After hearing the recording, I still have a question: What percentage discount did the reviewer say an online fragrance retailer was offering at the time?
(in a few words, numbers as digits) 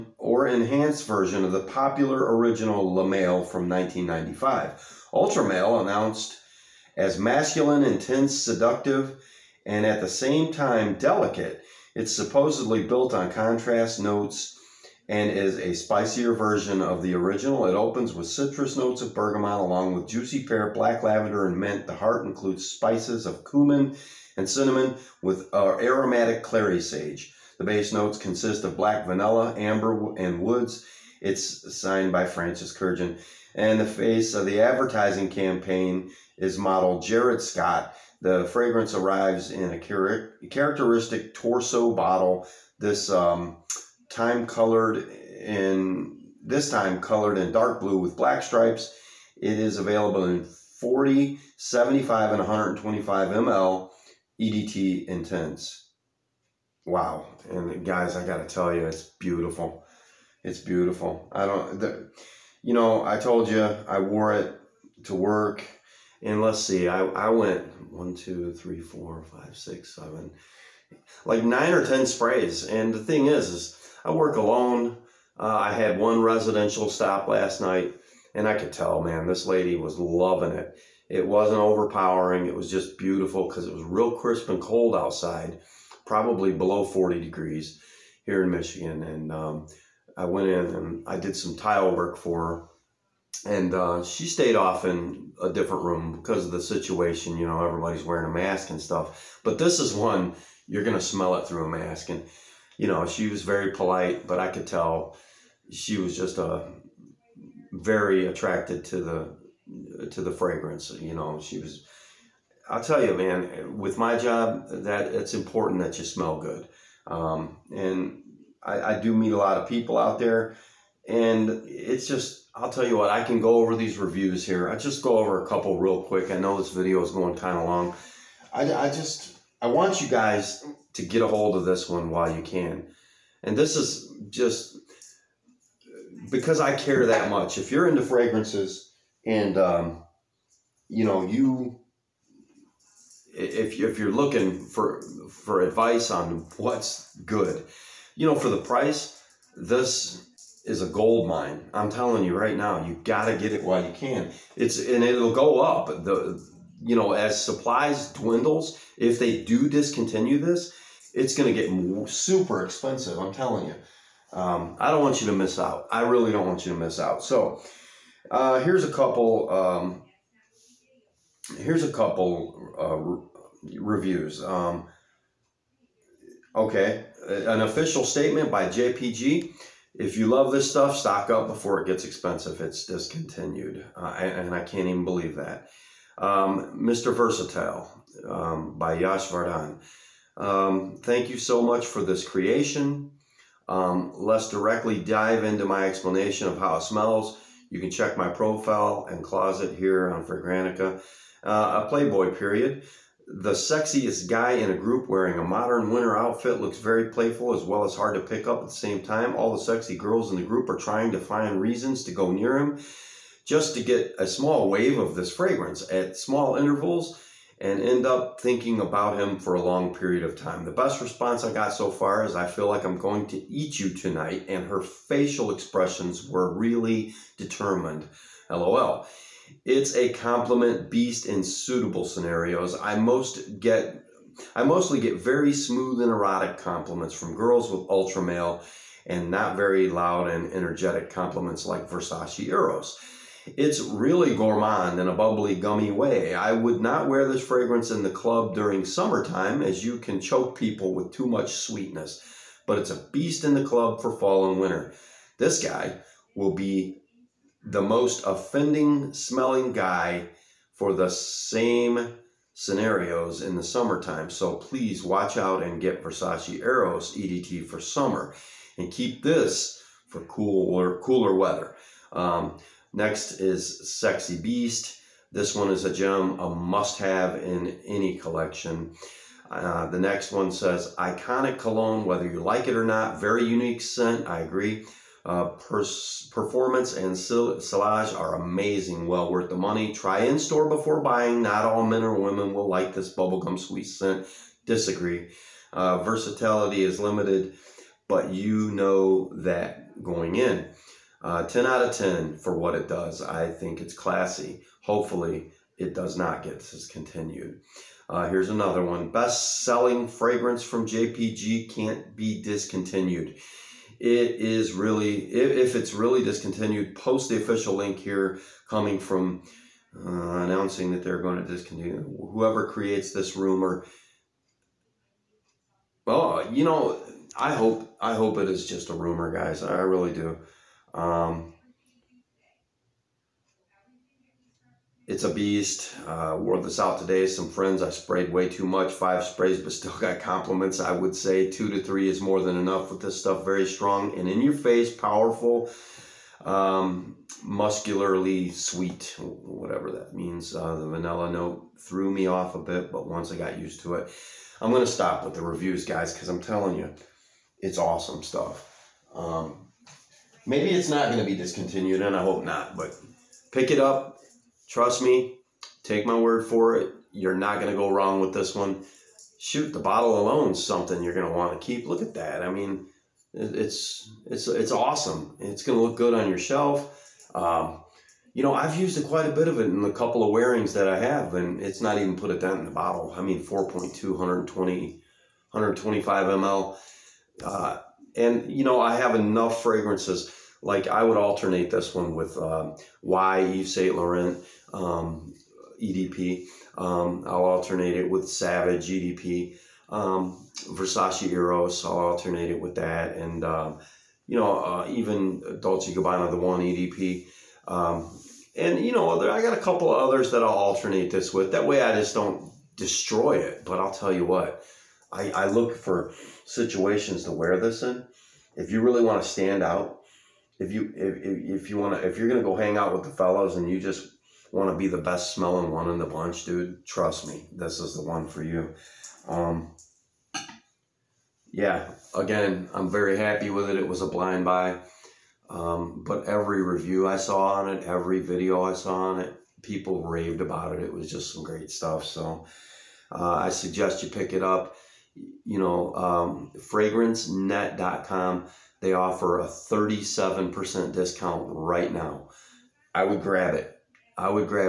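37%.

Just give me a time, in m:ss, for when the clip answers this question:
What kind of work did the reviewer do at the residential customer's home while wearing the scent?
1:31.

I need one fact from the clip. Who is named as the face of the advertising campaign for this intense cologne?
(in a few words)
Jared Scott.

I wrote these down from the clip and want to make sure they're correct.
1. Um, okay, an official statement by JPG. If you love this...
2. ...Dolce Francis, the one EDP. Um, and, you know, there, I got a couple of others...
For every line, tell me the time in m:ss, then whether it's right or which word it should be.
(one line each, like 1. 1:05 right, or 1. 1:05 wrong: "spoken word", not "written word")
1. 2:54 right
2. 6:45 wrong: "Gabbana", not "Francis".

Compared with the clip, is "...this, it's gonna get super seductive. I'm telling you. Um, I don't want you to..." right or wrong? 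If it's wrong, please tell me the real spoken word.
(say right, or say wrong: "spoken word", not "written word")
wrong: "expensive", not "seductive".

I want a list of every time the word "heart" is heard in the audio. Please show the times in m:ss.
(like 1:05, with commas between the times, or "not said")
0:21.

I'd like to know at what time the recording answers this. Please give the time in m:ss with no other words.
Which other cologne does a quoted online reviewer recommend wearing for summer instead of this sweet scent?
4:26.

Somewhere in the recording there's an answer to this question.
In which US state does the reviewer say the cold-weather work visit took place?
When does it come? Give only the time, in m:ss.
1:28.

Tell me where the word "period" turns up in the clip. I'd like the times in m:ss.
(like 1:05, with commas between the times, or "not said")
3:22, 3:39.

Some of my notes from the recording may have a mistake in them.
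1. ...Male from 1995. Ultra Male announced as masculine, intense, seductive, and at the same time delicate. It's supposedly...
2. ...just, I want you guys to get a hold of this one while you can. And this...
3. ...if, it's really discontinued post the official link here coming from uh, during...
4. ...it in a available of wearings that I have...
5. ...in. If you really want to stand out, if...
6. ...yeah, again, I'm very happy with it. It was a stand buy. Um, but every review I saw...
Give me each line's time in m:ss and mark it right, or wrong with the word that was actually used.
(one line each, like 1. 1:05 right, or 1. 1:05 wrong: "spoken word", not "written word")
1. 0:03 right
2. 2:08 right
3. 5:15 wrong: "announcing", not "during"
4. 6:19 wrong: "couple", not "available"
5. 6:57 right
6. 7:11 wrong: "blind", not "stand".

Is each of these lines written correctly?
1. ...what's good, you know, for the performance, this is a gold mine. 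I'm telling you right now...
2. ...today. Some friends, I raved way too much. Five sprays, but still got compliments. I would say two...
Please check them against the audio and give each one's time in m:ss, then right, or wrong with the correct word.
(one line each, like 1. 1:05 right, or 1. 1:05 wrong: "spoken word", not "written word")
1. 2:26 wrong: "price", not "performance"
2. 5:36 wrong: "sprayed", not "raved".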